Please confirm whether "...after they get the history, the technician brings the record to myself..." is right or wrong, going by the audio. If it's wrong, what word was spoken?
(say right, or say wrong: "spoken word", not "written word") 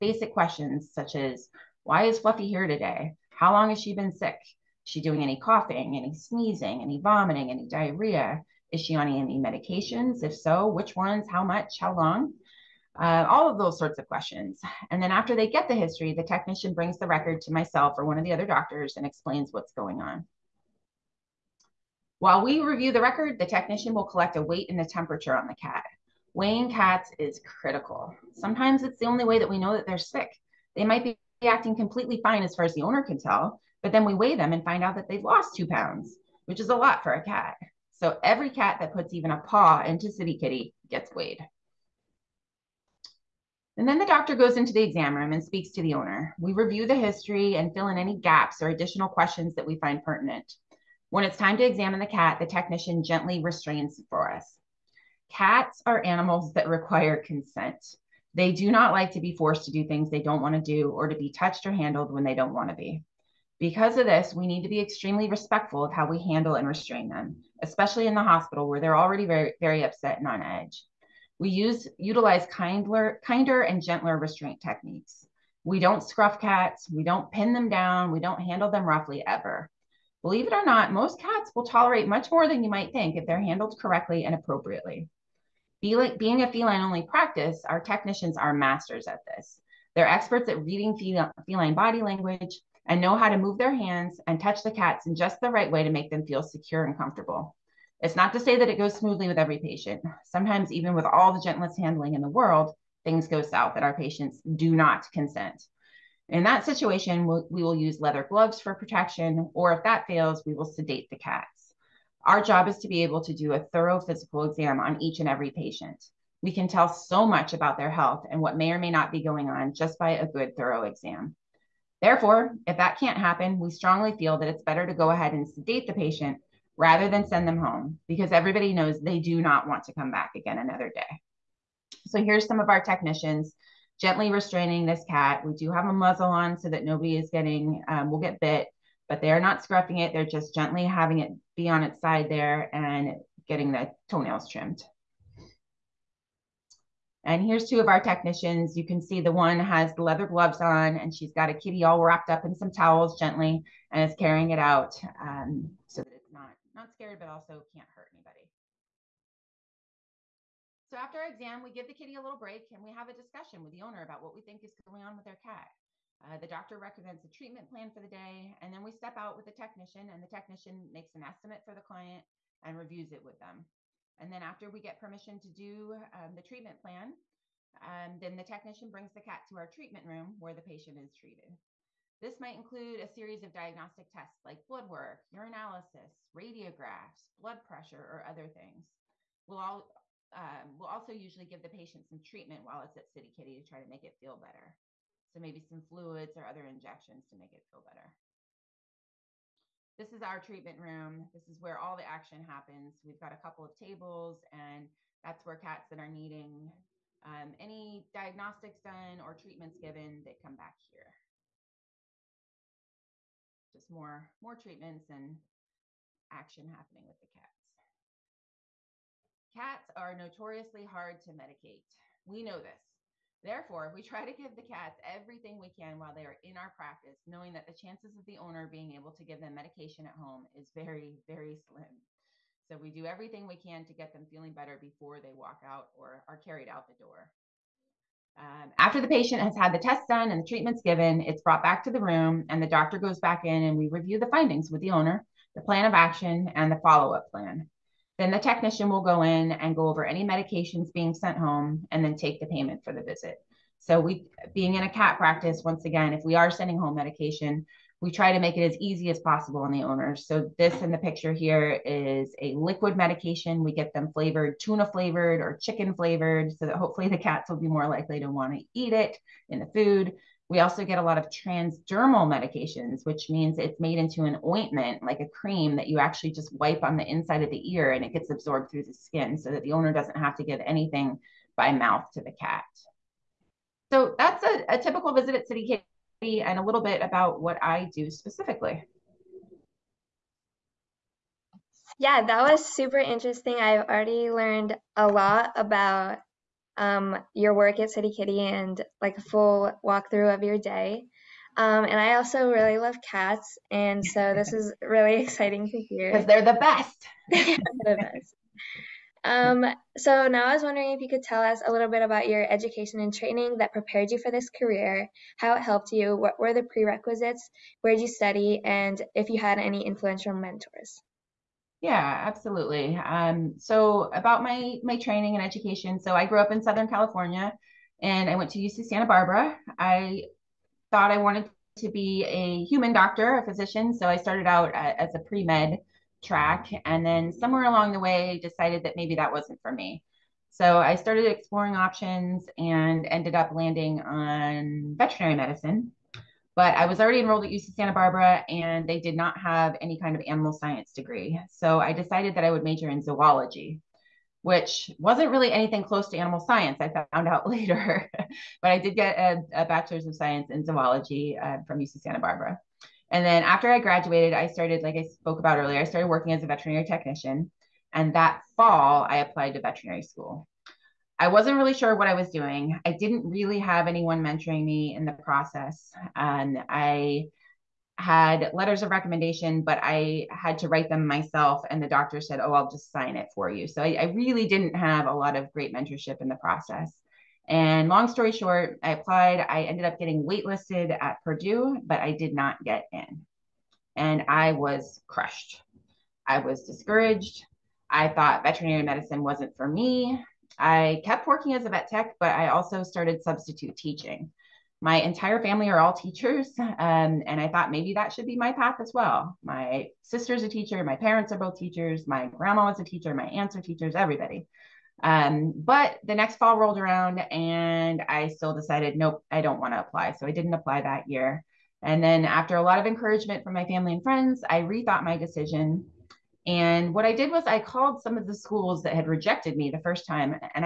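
right.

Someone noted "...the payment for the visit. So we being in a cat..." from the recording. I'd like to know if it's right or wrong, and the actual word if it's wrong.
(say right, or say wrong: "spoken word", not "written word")
right.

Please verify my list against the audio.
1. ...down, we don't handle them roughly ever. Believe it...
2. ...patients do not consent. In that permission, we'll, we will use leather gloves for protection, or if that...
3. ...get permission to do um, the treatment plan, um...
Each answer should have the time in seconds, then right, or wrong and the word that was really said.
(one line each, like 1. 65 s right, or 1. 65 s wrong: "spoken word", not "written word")
1. 77 s right
2. 103 s wrong: "situation", not "permission"
3. 174 s right.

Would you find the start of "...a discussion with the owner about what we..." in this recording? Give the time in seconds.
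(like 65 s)
163 s.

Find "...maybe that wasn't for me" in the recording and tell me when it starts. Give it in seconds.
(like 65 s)
338 s.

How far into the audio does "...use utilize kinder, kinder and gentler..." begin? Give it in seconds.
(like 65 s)
71 s.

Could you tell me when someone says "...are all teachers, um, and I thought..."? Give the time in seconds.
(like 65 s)
405 s.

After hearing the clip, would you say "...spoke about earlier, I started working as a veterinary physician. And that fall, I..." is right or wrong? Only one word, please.
wrong.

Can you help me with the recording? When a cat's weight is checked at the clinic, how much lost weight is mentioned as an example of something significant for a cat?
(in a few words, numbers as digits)
2 pounds.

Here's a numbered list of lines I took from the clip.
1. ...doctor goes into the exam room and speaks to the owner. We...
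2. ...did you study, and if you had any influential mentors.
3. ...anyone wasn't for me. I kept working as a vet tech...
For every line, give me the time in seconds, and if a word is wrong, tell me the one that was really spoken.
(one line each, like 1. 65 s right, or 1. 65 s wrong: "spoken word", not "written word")
1. 44 s right
2. 317 s right
3. 398 s wrong: "medicine", not "anyone".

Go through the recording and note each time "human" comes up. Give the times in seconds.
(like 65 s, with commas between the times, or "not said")
332 s.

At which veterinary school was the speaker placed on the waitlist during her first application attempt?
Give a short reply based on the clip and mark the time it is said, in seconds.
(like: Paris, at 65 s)
Purdue, at 391 s.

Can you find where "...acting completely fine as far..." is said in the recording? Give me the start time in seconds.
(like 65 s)
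31 s.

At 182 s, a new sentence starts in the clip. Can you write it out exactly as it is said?
This might include a series of diagnostic tests like blood work, urinalysis, radiographs, blood pressure, or other things.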